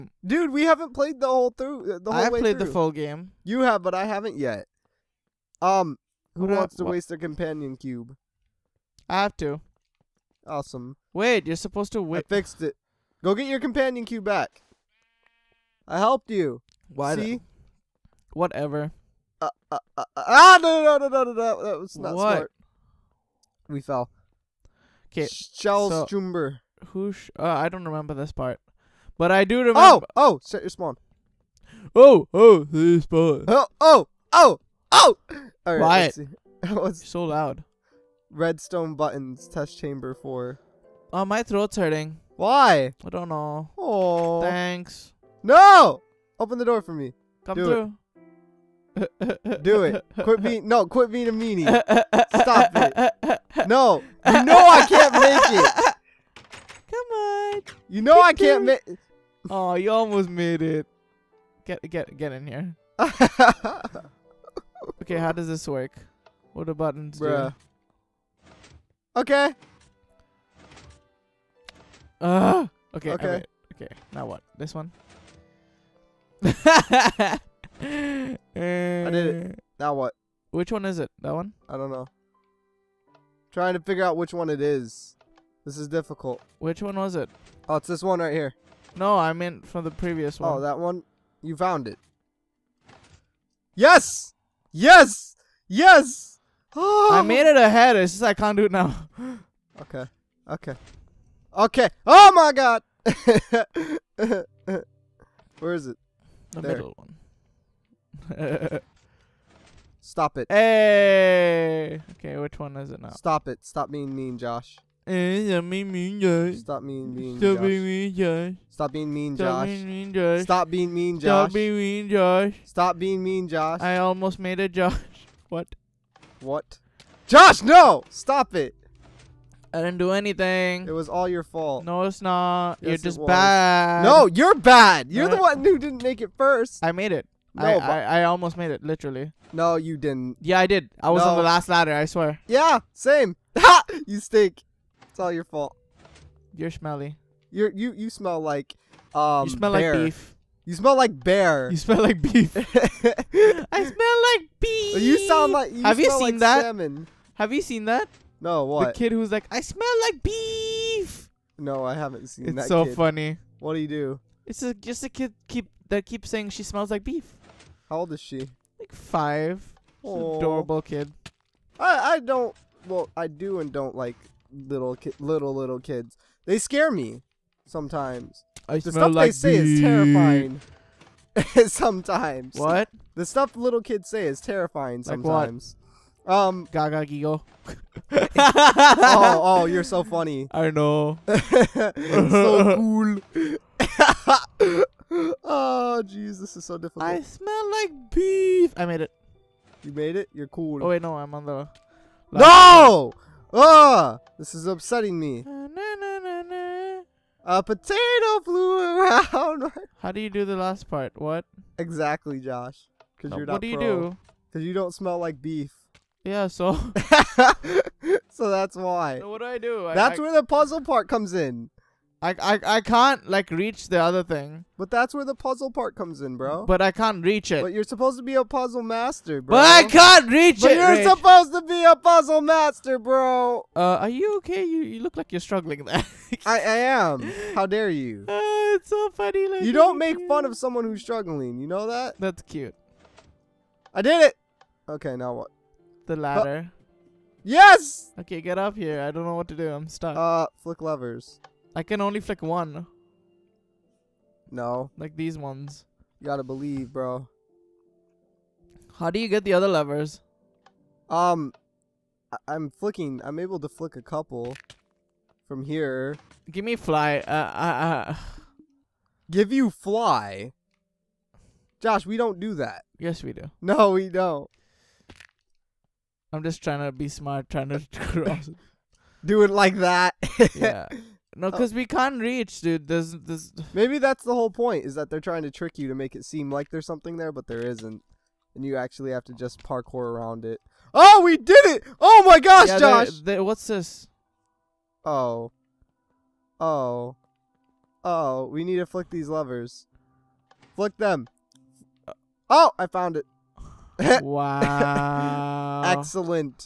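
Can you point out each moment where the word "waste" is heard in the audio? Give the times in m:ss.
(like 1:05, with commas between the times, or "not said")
0:06.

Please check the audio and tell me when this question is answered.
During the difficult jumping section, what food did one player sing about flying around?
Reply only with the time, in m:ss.
3:27.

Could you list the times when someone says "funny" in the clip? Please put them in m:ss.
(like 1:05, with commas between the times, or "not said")
2:42, 3:10, 3:59.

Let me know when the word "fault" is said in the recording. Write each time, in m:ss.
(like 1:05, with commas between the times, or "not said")
2:11, 2:25.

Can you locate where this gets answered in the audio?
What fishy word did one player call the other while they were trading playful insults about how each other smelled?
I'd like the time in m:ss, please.
2:36.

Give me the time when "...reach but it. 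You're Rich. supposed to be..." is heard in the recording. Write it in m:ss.
3:50.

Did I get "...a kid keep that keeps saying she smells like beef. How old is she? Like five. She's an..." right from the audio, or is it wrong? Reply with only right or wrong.
right.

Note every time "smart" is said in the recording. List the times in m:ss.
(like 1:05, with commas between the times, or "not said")
0:22, 4:37.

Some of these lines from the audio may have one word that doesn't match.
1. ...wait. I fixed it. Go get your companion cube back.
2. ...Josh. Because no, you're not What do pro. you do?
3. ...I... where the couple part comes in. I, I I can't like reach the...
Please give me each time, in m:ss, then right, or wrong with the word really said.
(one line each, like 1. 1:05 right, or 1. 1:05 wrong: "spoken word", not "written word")
1. 0:12 right
2. 3:32 right
3. 3:40 wrong: "puzzle", not "couple".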